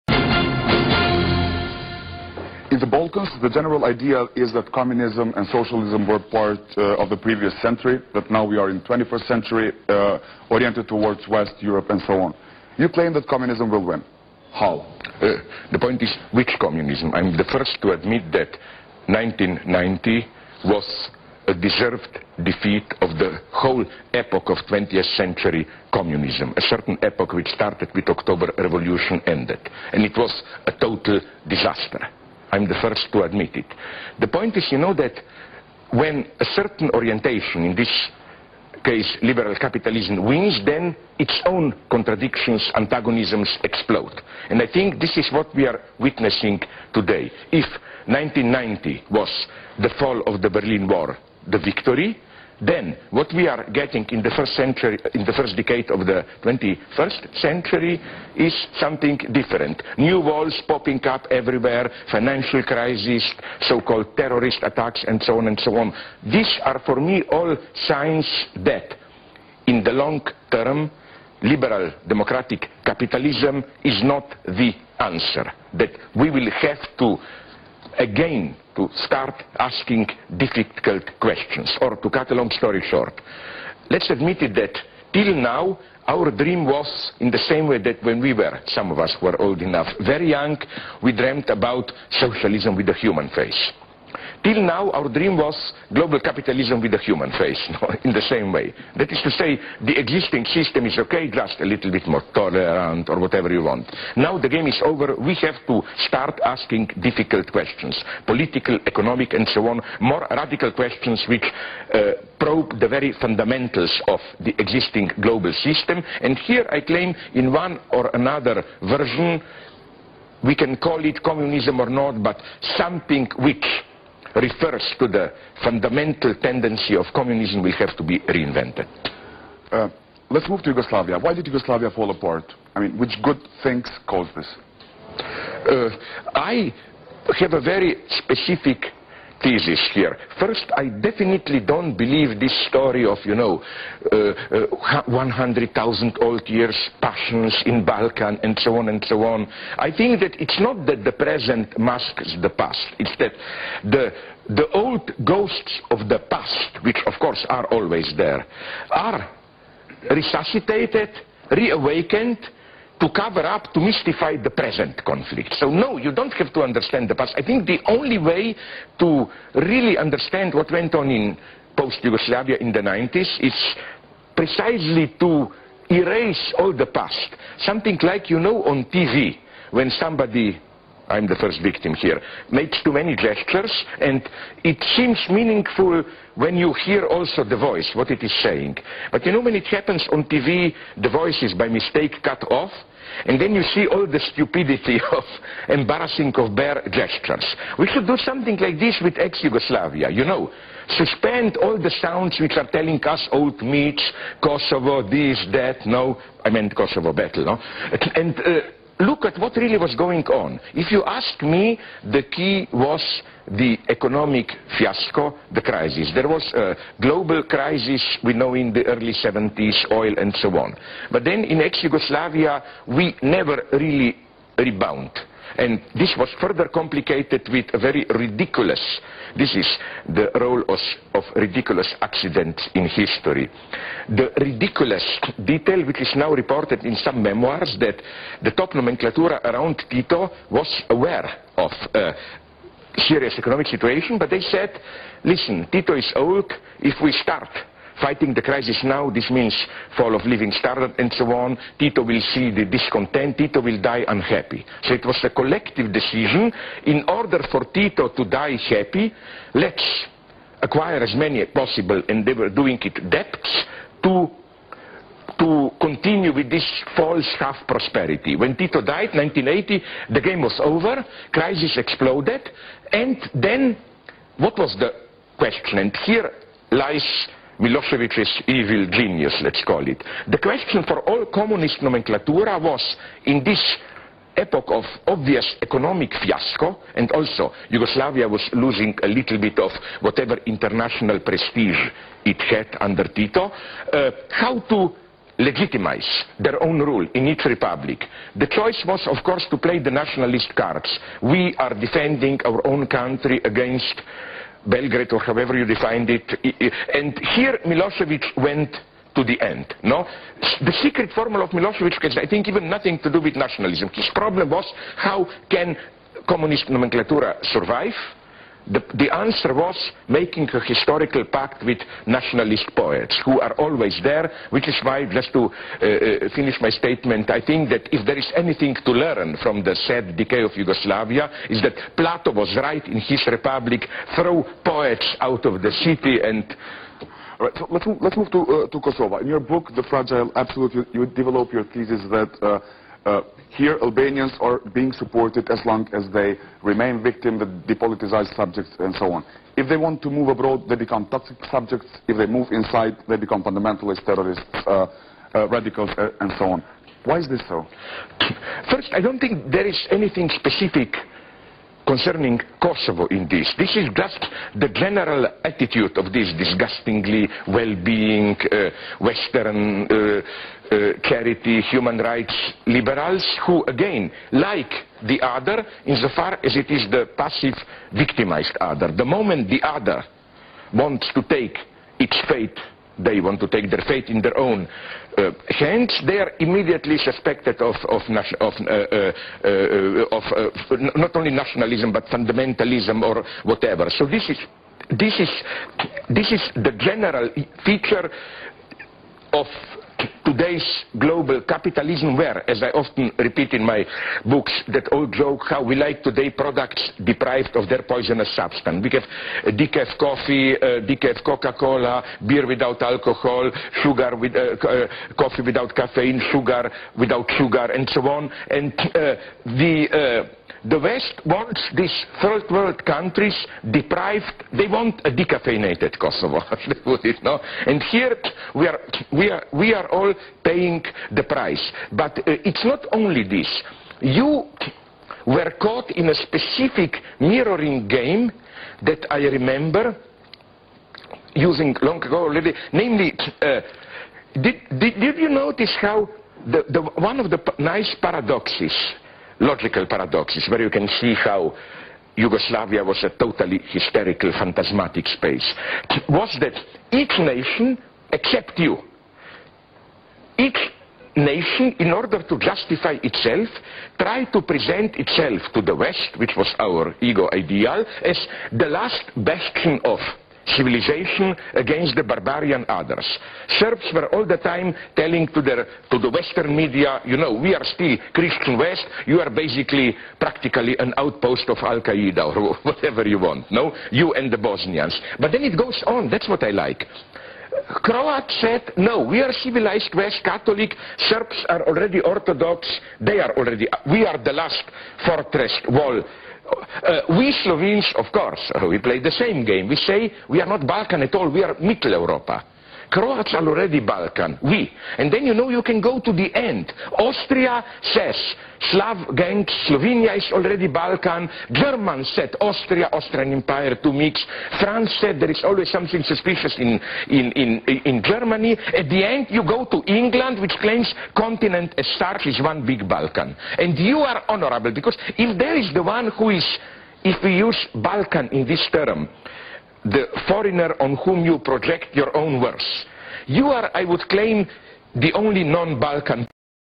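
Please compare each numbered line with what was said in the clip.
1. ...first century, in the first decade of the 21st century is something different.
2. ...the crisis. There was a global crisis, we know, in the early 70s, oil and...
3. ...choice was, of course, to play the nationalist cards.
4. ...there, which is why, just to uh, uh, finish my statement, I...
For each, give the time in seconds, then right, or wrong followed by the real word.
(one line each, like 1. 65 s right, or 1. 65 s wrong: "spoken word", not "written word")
1. 54 s right
2. 215 s right
3. 298 s right
4. 324 s right.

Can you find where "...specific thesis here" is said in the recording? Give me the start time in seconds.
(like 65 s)
138 s.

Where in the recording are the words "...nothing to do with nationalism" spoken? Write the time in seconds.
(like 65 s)
312 s.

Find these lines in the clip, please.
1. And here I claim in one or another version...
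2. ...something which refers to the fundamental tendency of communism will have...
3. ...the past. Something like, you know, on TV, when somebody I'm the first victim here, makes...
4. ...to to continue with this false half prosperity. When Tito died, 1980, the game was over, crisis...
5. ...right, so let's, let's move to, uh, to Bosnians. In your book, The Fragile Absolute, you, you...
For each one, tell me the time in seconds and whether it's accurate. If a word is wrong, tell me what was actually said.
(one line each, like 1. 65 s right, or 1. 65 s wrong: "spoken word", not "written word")
1. 116 s right
2. 122 s right
3. 176 s right
4. 264 s right
5. 337 s wrong: "Kosovo", not "Bosnians".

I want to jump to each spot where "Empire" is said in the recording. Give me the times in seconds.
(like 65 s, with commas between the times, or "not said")
513 s.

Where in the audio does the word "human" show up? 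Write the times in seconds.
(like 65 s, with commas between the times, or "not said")
92 s, 96 s, 371 s.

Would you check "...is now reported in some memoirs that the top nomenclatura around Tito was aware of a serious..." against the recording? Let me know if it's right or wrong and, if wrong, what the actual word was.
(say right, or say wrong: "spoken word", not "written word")
right.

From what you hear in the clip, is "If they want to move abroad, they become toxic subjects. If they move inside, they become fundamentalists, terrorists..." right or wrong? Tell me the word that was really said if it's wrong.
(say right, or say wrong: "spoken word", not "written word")
right.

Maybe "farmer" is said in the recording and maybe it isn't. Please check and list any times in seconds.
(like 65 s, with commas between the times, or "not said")
not said.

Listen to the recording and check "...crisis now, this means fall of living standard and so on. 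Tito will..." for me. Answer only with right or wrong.
right.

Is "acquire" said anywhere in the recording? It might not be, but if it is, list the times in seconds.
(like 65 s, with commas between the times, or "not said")
260 s.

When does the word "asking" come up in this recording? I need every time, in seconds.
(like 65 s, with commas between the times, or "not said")
79 s, 106 s.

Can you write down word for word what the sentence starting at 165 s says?
So no, you don't have to understand the past.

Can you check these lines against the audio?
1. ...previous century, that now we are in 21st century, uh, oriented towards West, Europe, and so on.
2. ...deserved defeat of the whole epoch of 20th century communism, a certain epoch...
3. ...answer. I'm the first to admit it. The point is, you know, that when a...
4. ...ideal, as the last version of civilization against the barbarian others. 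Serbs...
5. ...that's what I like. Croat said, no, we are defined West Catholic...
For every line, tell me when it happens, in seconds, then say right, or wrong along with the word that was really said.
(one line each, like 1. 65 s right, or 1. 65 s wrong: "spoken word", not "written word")
1. 7 s right
2. 21 s right
3. 31 s wrong: "disaster", not "answer"
4. 467 s wrong: "bastion", not "version"
5. 486 s wrong: "civilized", not "defined".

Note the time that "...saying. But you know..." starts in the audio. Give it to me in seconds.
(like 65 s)
188 s.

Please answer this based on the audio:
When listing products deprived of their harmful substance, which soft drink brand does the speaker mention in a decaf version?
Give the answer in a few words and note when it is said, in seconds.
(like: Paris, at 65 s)
Coca-Cola, at 411 s.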